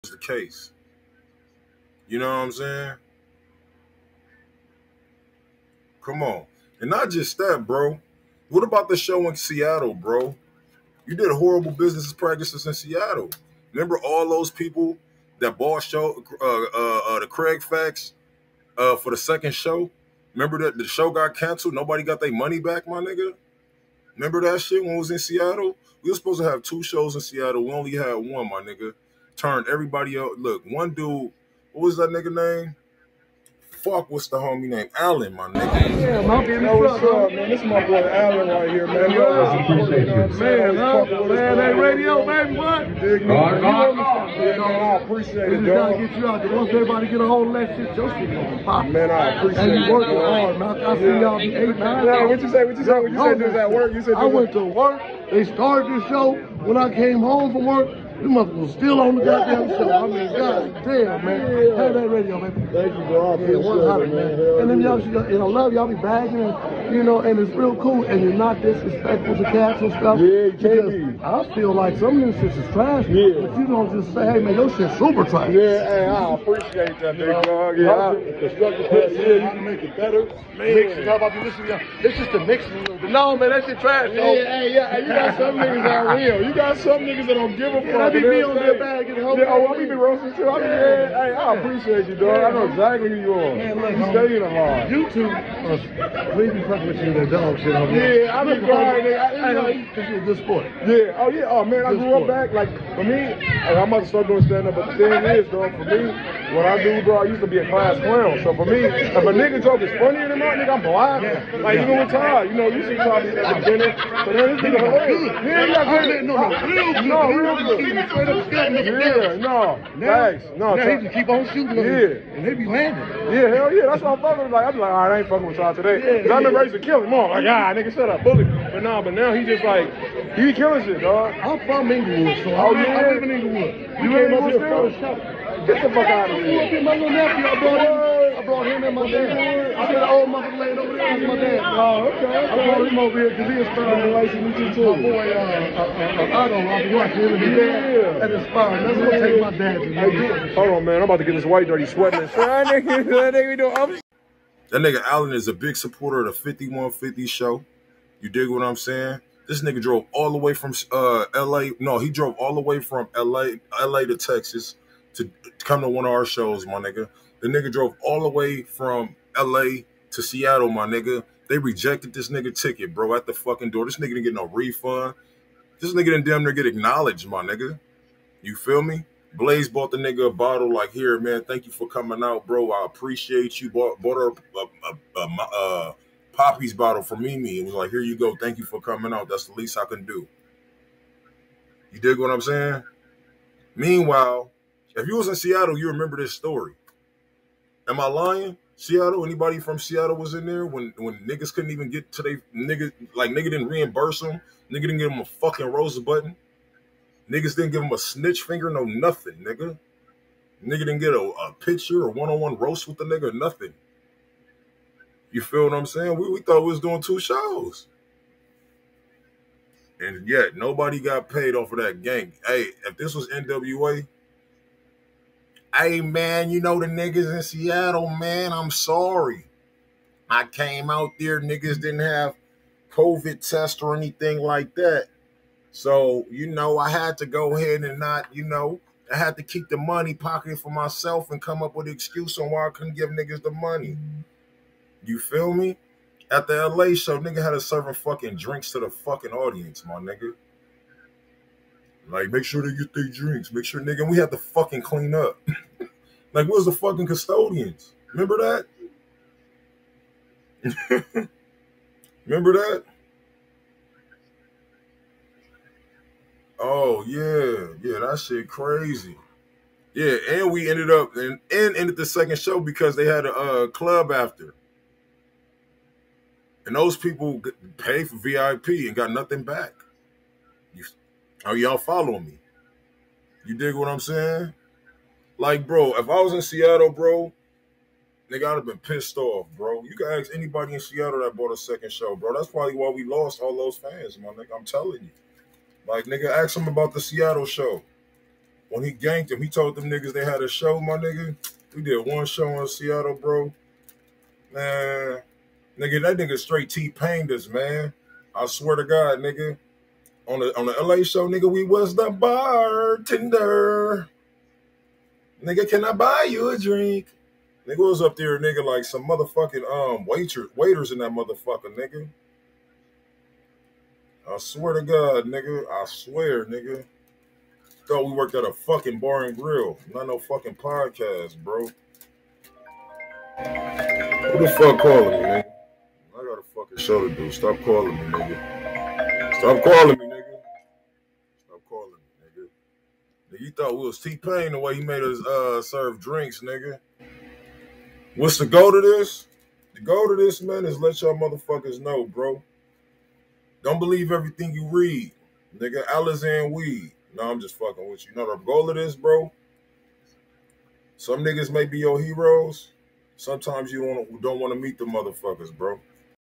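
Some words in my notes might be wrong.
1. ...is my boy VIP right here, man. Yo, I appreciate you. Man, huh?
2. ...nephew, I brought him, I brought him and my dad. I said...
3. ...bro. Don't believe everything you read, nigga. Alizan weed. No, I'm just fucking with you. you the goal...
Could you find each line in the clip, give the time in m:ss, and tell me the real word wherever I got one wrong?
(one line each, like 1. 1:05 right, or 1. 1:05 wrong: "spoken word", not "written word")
1. 0:37 wrong: "Allen", not "VIP"
2. 2:17 right
3. 5:52 right.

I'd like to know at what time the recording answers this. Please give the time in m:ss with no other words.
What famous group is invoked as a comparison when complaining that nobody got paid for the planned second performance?
3:42.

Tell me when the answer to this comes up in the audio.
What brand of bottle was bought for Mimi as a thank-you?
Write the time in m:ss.
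3:06.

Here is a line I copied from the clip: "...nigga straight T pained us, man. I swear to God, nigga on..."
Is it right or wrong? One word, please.
right.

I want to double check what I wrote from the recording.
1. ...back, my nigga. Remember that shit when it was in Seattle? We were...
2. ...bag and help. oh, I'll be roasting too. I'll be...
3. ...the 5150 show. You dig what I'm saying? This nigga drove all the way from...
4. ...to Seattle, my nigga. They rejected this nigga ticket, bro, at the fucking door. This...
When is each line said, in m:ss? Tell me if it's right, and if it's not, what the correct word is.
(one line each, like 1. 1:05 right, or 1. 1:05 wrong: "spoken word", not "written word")
1. 0:22 right
2. 1:28 right
3. 2:36 right
4. 2:50 right.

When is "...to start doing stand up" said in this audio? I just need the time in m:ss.
1:44.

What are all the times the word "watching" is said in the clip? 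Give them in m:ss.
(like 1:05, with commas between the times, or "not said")
2:26.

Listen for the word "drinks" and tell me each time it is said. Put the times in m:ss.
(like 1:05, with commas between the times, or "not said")
4:08, 4:13, 5:16, 5:45.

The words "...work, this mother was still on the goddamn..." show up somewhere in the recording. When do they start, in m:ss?
0:57.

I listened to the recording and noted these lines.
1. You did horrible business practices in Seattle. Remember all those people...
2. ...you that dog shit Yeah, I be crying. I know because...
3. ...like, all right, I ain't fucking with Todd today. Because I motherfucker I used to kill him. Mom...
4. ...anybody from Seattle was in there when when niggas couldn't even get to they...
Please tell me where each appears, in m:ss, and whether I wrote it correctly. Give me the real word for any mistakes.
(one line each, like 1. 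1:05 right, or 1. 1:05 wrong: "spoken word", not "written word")
1. 0:11 right
2. 1:36 right
3. 2:04 wrong: "remember", not "motherfucker"
4. 3:19 right.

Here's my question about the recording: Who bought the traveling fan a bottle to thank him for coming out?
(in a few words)
Blaze.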